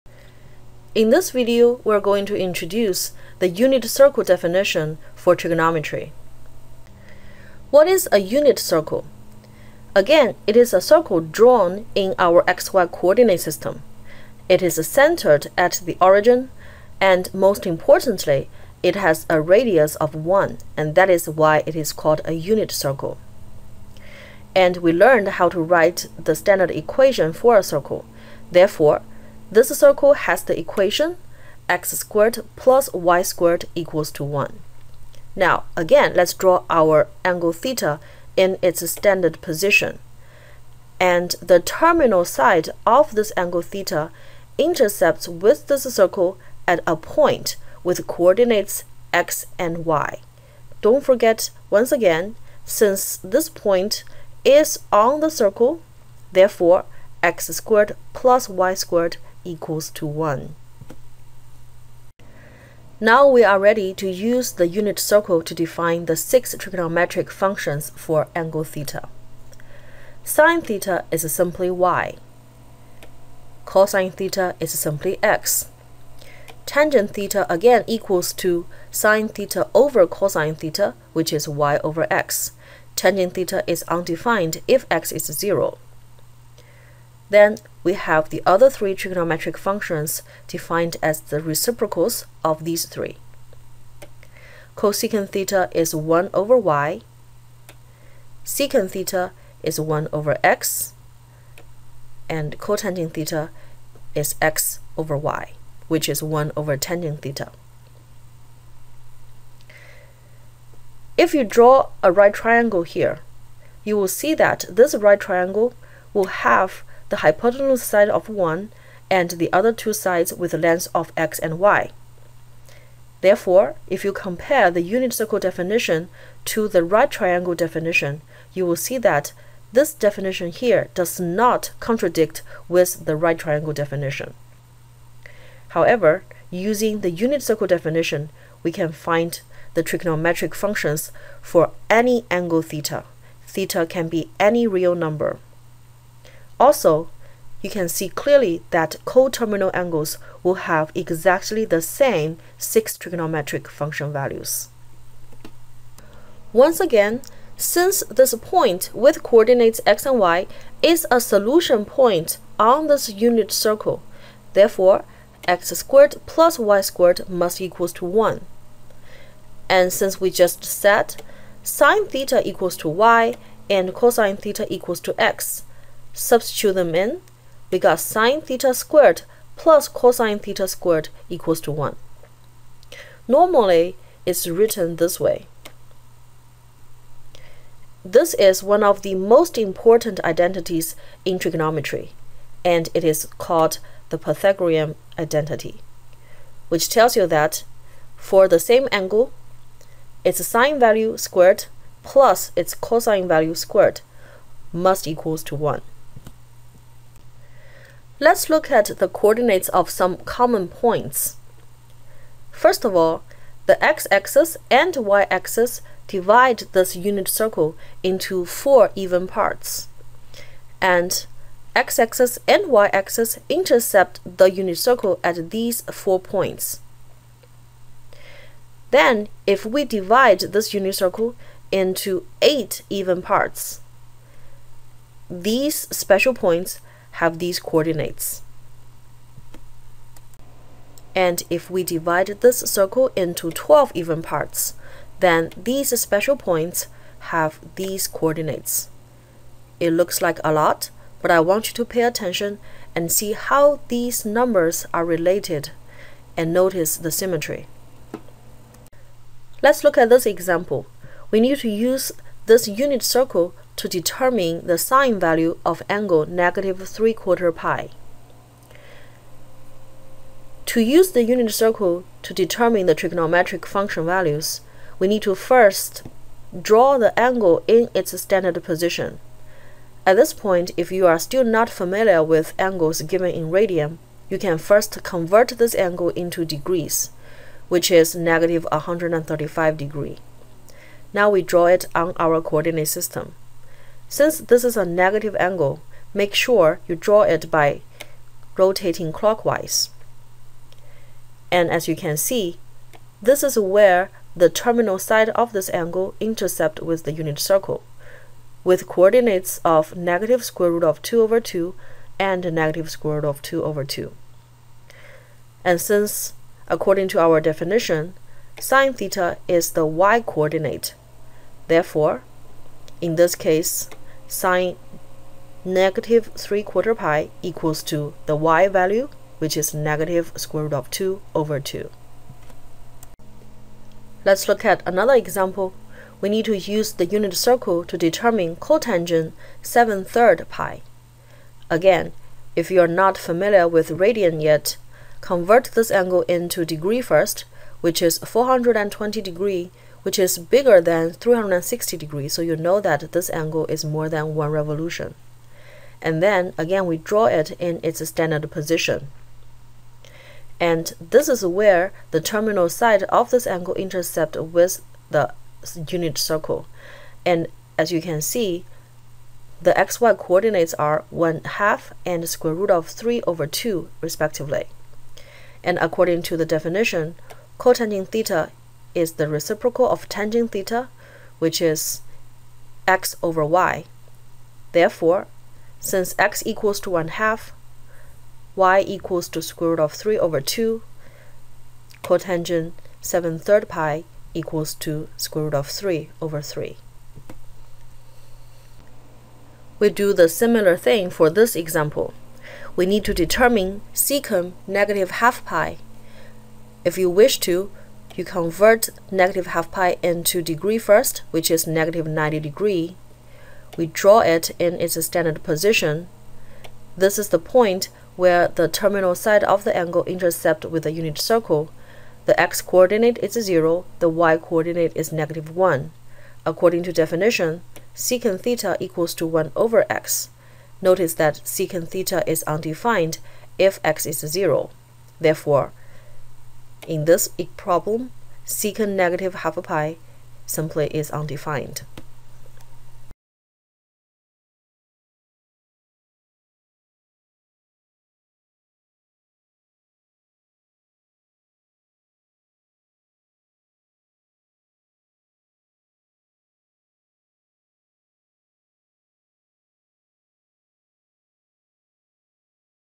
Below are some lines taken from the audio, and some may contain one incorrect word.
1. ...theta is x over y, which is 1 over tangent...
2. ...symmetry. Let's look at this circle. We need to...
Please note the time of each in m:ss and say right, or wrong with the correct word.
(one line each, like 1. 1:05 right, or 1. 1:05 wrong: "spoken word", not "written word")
1. 1:43 right
2. 4:17 wrong: "example", not "circle".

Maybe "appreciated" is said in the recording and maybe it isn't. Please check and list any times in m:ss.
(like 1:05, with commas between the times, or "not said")
not said.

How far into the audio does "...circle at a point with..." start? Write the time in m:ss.
0:45.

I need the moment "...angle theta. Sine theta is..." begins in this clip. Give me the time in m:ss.
1:08.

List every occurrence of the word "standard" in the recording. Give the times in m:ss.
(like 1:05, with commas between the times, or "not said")
0:26, 0:38, 4:38, 5:58, 6:55.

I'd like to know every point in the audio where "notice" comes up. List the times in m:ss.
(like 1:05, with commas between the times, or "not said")
4:16, 7:10.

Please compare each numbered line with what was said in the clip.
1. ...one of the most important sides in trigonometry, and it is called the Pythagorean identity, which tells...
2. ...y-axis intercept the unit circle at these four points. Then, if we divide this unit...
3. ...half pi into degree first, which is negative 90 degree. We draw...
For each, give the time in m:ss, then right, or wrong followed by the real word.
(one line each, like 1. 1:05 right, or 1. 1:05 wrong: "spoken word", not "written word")
1. 3:08 wrong: "identities", not "sides"
2. 3:42 right
3. 6:49 right.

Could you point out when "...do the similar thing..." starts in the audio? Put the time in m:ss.
6:39.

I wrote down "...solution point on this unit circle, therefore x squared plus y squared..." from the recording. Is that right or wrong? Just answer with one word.
right.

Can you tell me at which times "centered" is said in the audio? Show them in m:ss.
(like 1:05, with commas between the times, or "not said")
0:14.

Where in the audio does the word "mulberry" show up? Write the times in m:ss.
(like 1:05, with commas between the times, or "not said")
not said.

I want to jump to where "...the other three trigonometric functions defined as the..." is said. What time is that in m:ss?
1:28.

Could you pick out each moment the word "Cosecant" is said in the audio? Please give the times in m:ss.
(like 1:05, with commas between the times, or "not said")
1:34.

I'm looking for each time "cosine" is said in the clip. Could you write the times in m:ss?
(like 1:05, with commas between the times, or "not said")
1:13, 1:20, 2:53, 2:59, 3:22.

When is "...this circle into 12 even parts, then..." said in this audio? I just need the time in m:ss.
4:02.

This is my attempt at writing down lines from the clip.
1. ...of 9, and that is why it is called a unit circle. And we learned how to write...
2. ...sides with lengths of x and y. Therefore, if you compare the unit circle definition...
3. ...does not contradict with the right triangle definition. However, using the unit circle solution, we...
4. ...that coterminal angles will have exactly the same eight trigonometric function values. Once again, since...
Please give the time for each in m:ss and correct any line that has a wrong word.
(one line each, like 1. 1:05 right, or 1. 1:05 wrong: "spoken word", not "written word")
1. 0:19 wrong: "1", not "9"
2. 1:59 right
3. 2:10 wrong: "definition", not "solution"
4. 2:28 wrong: "six", not "eight".